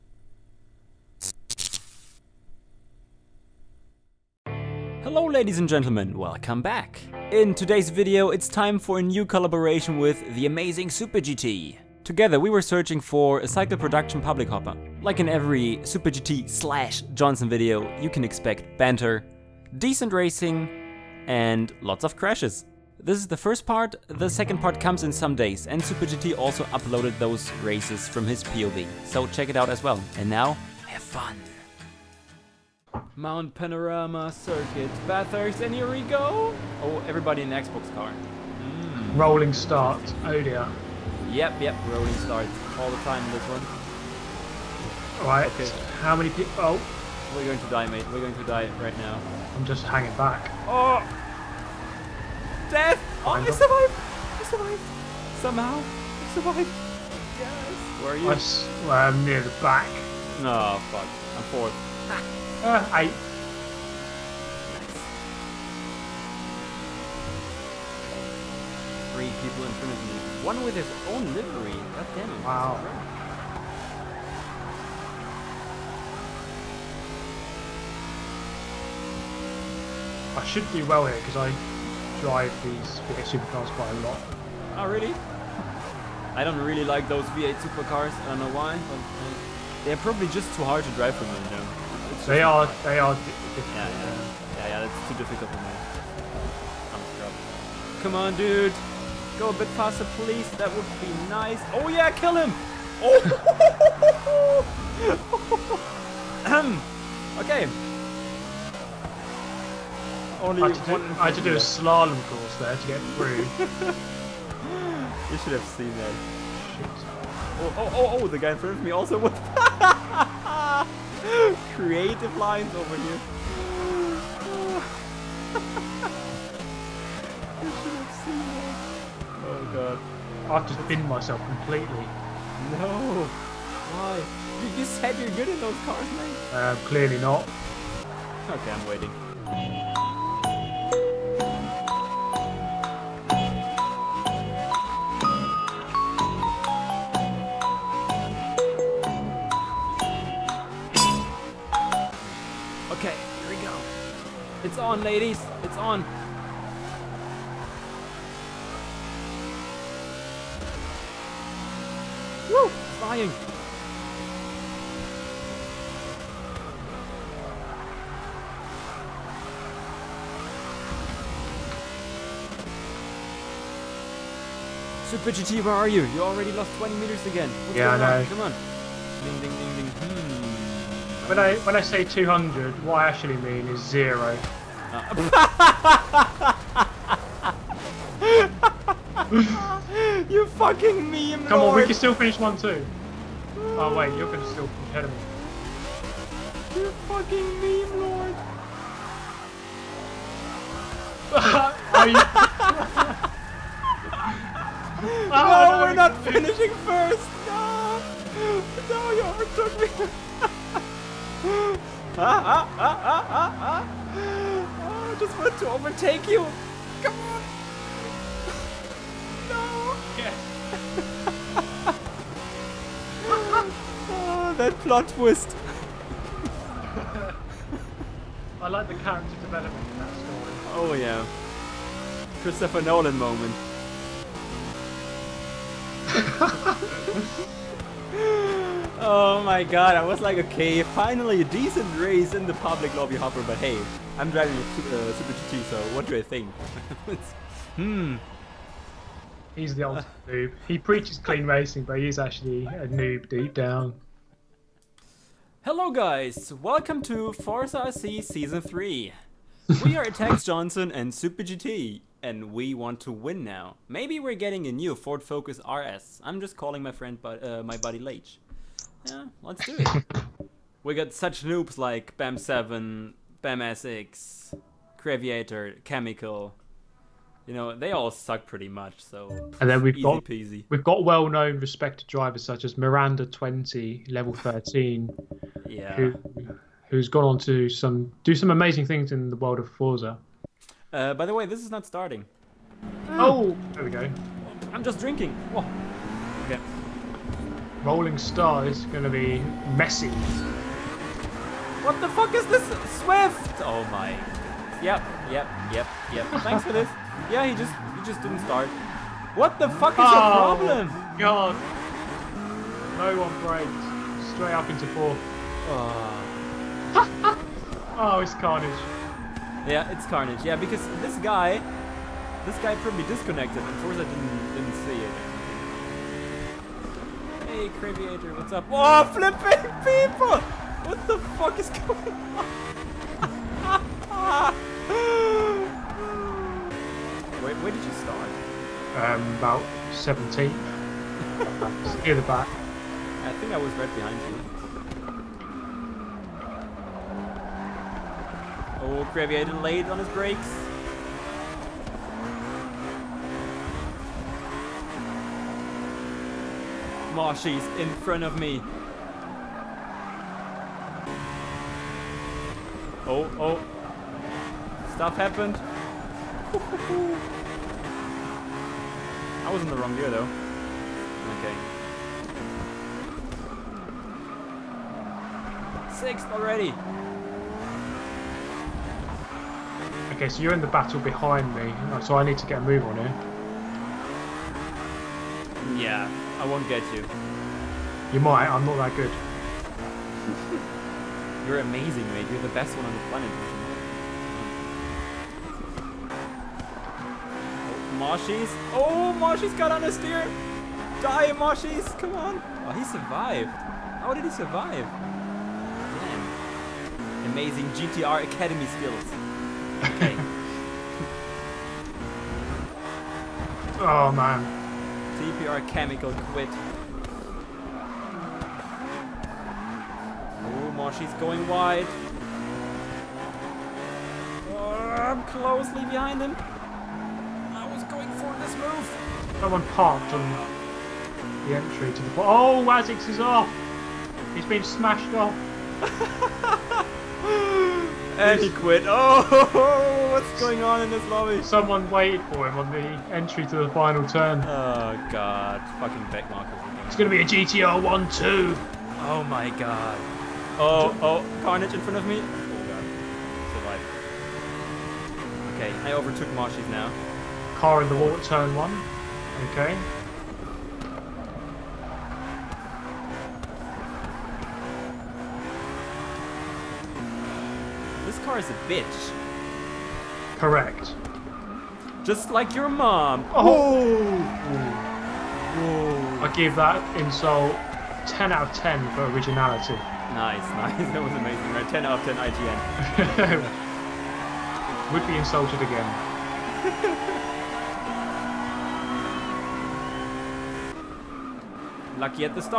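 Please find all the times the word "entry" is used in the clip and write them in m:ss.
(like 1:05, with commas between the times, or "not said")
7:11, 7:23.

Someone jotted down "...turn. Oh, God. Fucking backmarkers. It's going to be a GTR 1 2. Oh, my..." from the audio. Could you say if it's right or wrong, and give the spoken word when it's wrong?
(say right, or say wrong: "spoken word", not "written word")
right.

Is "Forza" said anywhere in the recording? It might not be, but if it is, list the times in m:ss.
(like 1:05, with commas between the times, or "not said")
4:17, 4:49, 5:23.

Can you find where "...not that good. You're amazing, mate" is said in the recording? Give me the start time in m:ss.
6:28.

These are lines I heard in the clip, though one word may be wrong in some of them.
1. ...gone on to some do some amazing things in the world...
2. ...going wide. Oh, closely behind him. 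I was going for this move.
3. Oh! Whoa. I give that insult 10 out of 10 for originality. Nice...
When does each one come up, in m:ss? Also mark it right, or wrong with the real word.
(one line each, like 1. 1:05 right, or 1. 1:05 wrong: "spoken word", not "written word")
1. 4:47 right
2. 7:01 right
3. 7:53 right.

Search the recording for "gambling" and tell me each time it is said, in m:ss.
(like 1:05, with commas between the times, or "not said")
not said.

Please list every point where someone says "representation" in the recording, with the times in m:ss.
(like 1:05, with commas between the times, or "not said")
not said.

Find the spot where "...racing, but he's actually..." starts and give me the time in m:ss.
4:11.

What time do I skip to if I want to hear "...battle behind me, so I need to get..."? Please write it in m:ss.
6:20.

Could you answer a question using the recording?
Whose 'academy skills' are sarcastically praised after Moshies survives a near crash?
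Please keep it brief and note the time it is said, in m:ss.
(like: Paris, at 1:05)
GTR Academy, at 6:47.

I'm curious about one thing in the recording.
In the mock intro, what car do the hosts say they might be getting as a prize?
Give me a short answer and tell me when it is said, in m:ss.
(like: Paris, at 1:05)
Ford Focus RS, at 4:24.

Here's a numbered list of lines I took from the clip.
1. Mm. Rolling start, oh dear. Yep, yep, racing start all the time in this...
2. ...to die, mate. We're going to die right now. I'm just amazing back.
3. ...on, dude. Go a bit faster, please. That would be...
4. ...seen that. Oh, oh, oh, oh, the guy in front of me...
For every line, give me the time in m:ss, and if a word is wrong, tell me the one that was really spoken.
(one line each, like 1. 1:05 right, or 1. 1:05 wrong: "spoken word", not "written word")
1. 0:38 wrong: "rolling", not "racing"
2. 0:47 wrong: "hanging", not "amazing"
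3. 1:38 right
4. 1:55 right.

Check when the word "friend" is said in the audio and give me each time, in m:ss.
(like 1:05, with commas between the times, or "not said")
4:26.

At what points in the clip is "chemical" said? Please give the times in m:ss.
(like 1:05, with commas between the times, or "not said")
4:35, 6:55.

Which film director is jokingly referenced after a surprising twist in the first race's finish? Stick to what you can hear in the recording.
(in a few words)
Christopher Nolan.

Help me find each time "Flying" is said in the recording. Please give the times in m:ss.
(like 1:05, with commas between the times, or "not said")
2:42.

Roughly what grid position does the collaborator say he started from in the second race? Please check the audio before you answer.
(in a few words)
17.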